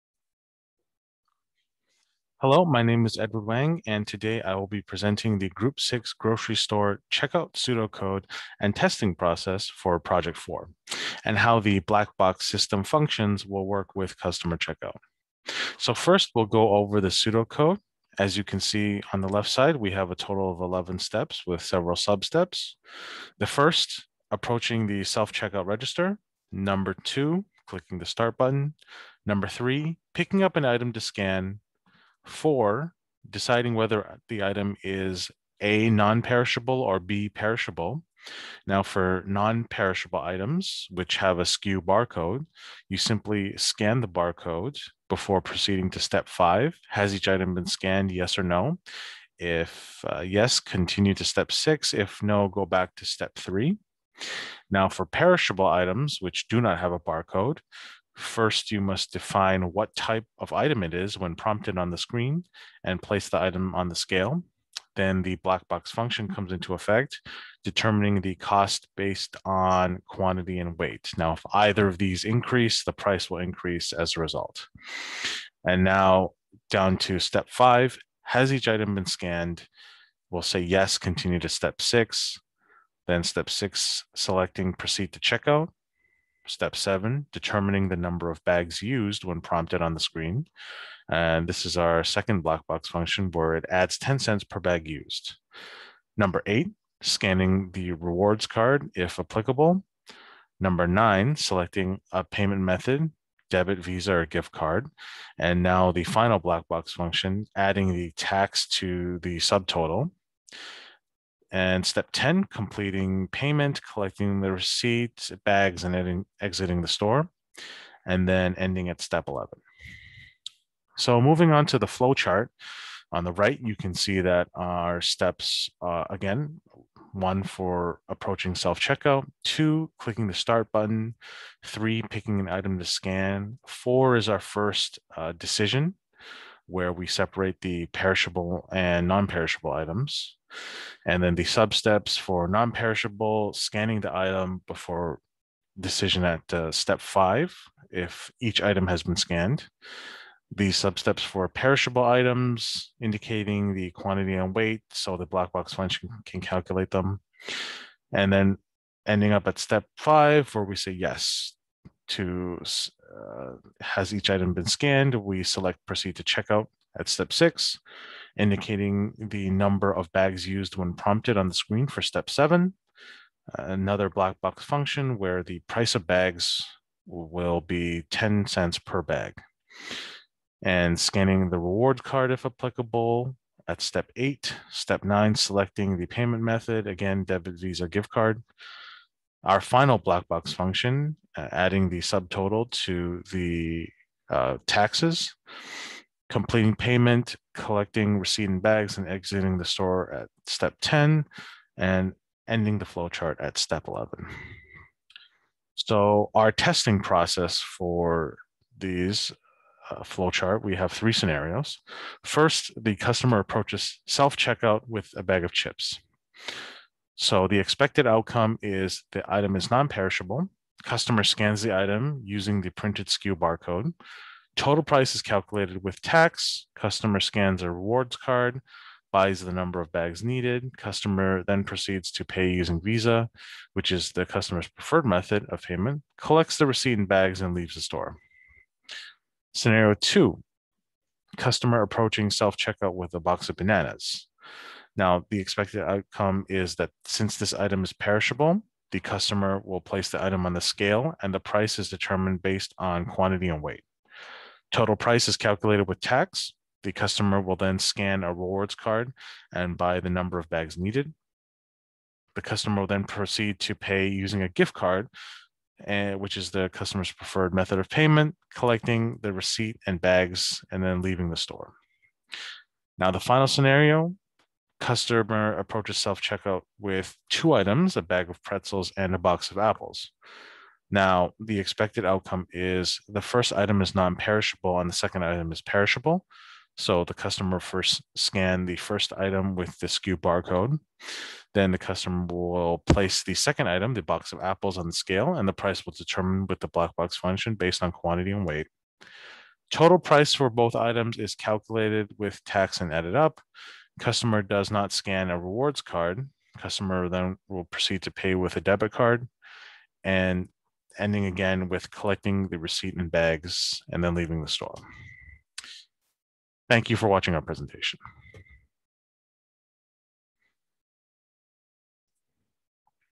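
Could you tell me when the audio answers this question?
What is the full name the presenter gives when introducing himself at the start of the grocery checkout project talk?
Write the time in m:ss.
0:03.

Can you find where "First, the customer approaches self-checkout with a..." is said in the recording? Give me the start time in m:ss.
3:32.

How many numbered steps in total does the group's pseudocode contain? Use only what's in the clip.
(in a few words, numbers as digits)
11.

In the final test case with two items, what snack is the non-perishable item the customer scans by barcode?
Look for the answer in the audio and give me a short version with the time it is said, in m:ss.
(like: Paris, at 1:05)
pretzels, at 4:37.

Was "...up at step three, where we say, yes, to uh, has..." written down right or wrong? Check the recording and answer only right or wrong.
wrong.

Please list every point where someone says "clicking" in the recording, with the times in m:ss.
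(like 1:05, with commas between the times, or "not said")
0:27, 2:09.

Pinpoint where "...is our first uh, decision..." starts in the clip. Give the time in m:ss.
2:14.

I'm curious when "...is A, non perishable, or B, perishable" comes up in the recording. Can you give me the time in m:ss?
0:34.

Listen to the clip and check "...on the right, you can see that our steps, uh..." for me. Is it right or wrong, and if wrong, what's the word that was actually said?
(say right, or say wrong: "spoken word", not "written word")
right.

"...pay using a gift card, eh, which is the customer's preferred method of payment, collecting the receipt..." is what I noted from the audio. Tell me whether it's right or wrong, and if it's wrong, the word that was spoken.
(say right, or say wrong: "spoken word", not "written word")
right.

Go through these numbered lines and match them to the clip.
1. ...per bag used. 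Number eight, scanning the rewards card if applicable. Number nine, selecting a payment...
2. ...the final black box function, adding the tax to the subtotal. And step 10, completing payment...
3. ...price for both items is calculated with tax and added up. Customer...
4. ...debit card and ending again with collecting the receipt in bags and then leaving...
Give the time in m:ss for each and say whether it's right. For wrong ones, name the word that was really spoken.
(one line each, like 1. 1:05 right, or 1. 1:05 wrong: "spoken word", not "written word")
1. 1:34 right
2. 1:45 right
3. 4:59 right
4. 5:08 right.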